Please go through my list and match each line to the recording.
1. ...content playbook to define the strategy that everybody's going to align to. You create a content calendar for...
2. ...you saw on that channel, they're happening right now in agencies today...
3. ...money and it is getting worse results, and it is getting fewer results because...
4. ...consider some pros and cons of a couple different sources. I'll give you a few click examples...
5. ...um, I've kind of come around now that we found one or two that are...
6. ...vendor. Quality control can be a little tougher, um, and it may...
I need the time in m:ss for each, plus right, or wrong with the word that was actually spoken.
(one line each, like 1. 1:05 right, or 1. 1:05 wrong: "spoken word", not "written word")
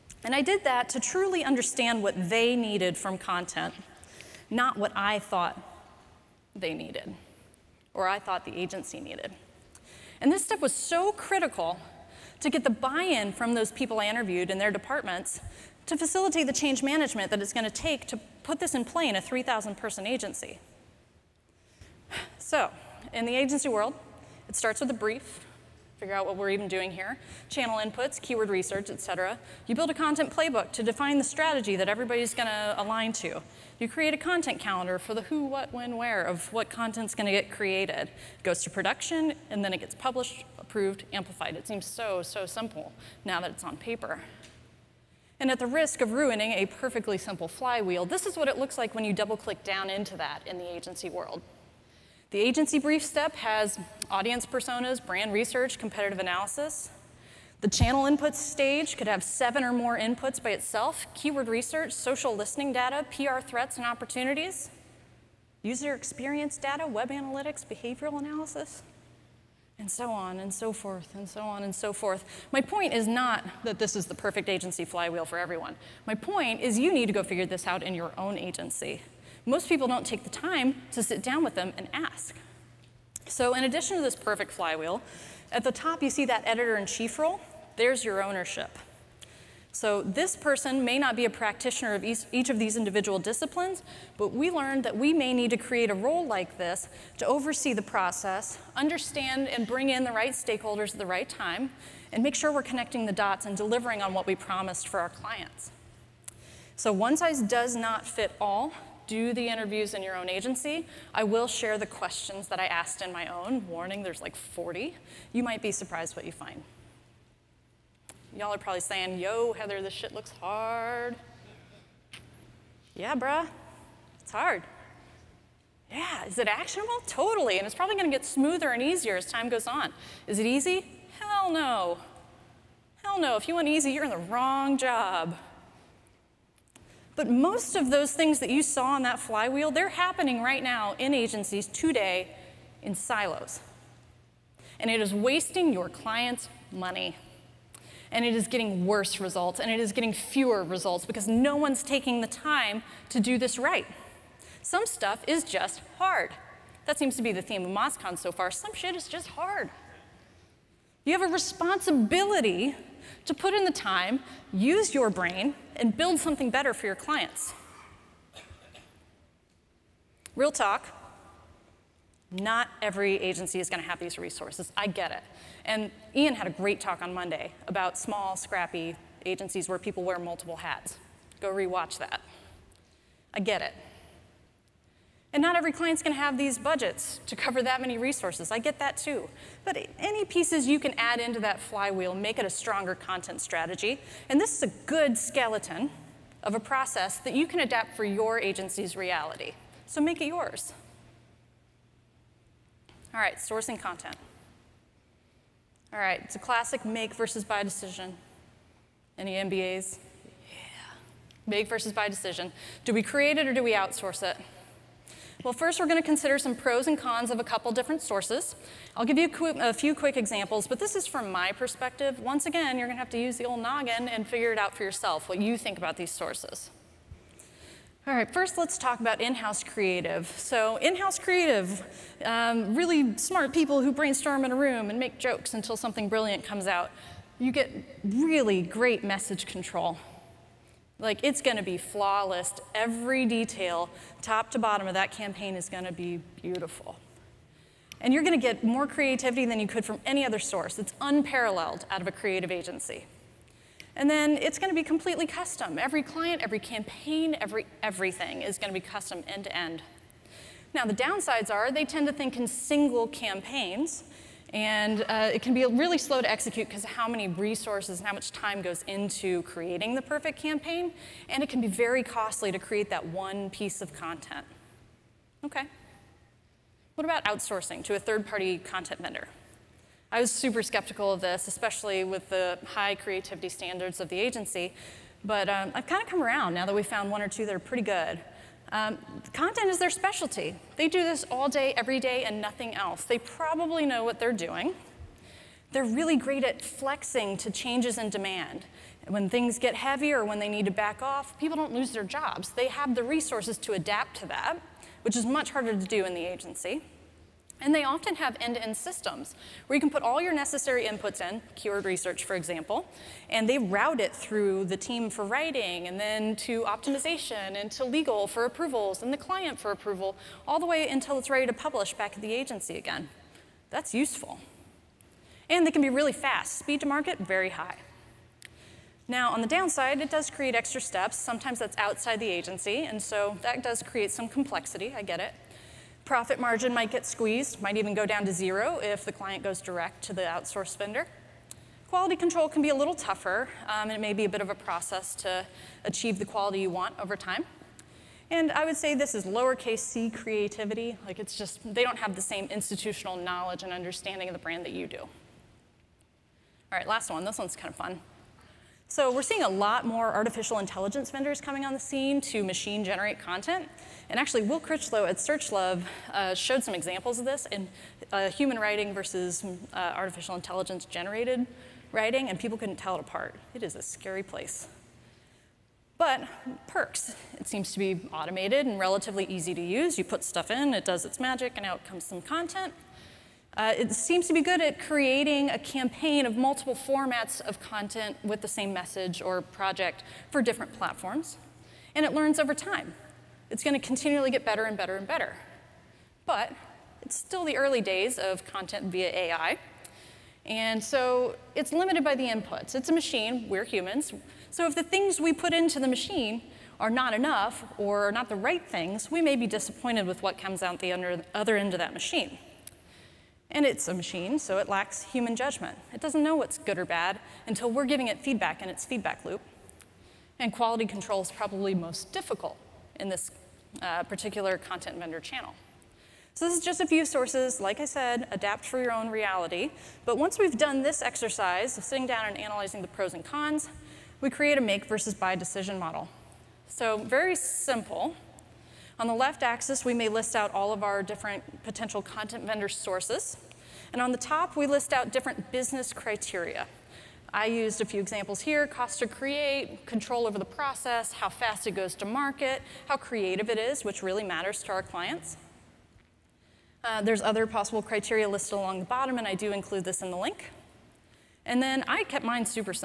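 1. 0:29 right
2. 2:18 wrong: "flywheel", not "channel"
3. 2:26 right
4. 3:36 wrong: "quick", not "click"
5. 4:45 right
6. 5:40 right.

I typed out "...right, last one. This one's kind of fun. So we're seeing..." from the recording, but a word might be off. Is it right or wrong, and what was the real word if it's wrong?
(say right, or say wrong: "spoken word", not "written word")
right.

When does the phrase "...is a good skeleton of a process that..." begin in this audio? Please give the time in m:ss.
3:14.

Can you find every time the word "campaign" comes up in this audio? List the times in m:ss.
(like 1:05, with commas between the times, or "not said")
4:05, 4:16, 4:23, 4:30, 6:25.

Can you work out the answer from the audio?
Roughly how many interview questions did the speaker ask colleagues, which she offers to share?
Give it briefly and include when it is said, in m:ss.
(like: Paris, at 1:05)
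40, at 1:54.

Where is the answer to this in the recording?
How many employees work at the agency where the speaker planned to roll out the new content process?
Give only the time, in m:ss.
0:19.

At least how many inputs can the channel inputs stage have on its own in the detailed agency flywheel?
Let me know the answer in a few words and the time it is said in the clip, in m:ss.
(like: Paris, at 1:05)
7, at 0:59.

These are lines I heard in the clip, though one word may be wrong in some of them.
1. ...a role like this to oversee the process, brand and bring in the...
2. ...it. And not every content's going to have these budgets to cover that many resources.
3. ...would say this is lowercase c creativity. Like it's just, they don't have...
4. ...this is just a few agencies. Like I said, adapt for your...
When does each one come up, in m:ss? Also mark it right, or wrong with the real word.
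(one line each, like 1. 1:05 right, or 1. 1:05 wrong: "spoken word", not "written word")
1. 1:35 wrong: "understand", not "brand"
2. 3:03 wrong: "client", not "content"
3. 5:48 right
4. 7:06 wrong: "sources", not "agencies".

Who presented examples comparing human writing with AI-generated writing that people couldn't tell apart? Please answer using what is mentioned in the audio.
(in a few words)
Will Critchlow.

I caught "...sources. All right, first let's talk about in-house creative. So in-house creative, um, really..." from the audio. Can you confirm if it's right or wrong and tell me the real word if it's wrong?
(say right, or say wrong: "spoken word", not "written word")
right.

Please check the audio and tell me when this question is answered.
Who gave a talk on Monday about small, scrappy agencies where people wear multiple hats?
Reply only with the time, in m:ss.
2:56.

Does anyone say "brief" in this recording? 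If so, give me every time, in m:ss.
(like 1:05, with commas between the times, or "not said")
0:24, 0:52.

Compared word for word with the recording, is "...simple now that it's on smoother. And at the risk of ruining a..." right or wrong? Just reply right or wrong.
wrong.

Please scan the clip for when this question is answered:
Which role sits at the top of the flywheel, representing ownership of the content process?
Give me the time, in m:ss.
1:26.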